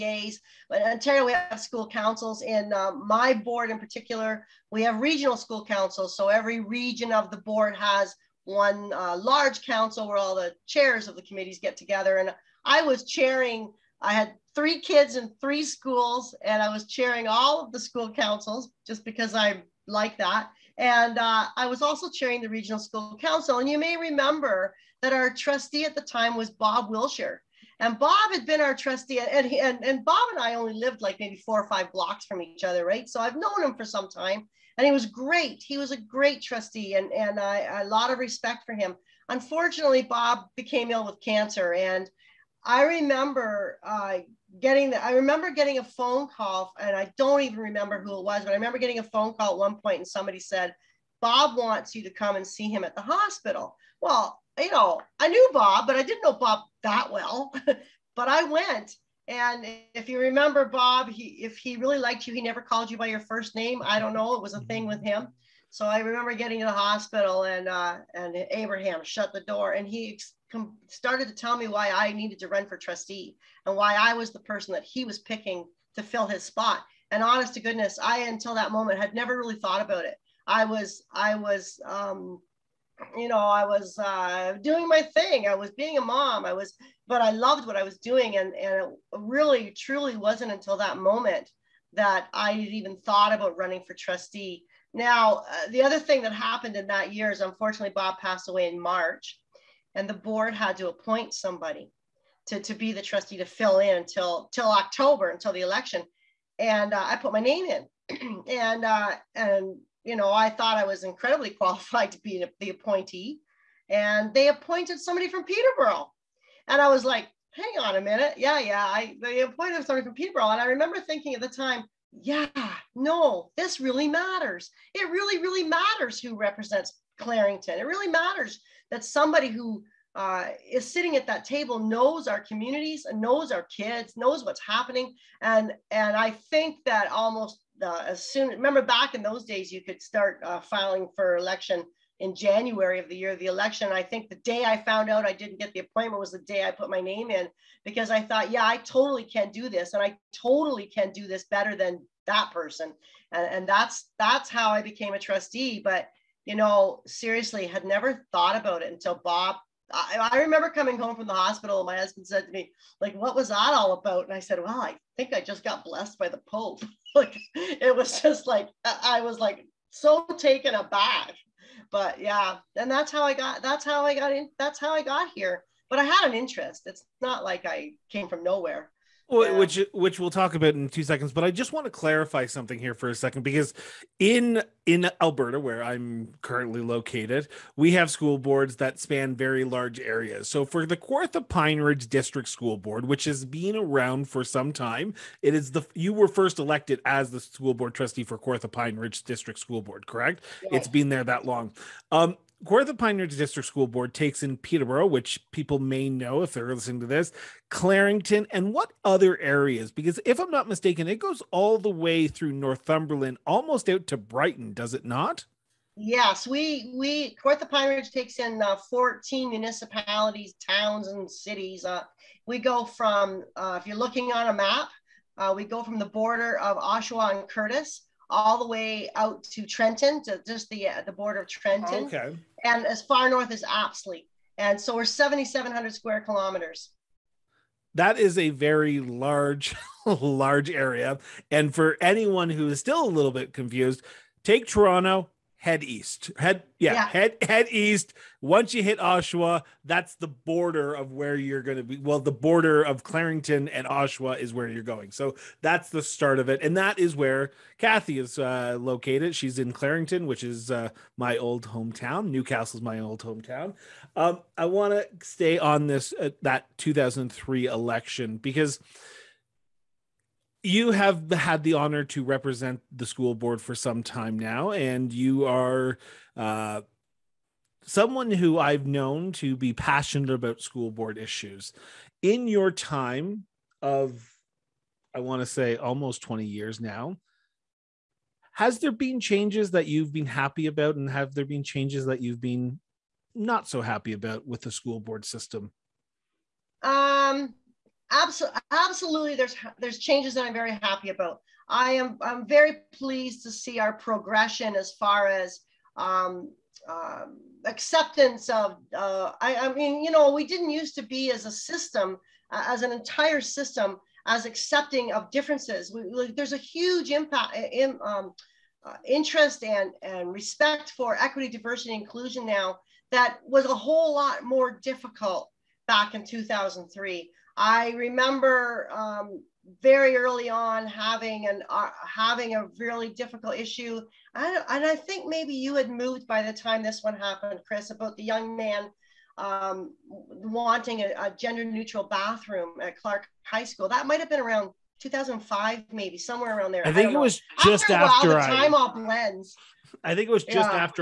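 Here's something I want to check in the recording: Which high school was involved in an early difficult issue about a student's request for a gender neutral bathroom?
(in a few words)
Clarke High School.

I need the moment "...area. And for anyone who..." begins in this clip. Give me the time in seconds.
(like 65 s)
240 s.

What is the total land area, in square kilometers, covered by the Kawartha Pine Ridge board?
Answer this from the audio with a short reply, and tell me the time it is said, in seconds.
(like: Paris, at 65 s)
7,700, at 235 s.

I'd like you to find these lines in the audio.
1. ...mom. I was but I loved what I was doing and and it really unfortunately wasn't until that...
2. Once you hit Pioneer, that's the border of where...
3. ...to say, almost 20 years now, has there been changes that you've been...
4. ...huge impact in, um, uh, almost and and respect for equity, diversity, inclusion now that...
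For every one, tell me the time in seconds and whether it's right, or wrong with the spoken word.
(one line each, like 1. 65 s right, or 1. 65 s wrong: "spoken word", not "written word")
1. 86 s wrong: "truly", not "unfortunately"
2. 248 s wrong: "Oshawa", not "Pioneer"
3. 285 s right
4. 316 s wrong: "interest", not "almost".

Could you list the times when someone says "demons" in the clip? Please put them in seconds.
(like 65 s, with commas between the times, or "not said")
not said.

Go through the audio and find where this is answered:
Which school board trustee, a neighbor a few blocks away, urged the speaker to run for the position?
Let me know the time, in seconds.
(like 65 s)
26 s.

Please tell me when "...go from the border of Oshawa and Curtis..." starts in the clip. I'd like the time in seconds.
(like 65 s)
225 s.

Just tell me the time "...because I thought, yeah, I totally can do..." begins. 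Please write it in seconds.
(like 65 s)
147 s.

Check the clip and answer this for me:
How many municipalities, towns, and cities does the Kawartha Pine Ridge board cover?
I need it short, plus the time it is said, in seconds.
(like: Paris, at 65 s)
14, at 218 s.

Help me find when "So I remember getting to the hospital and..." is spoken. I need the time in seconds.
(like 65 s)
65 s.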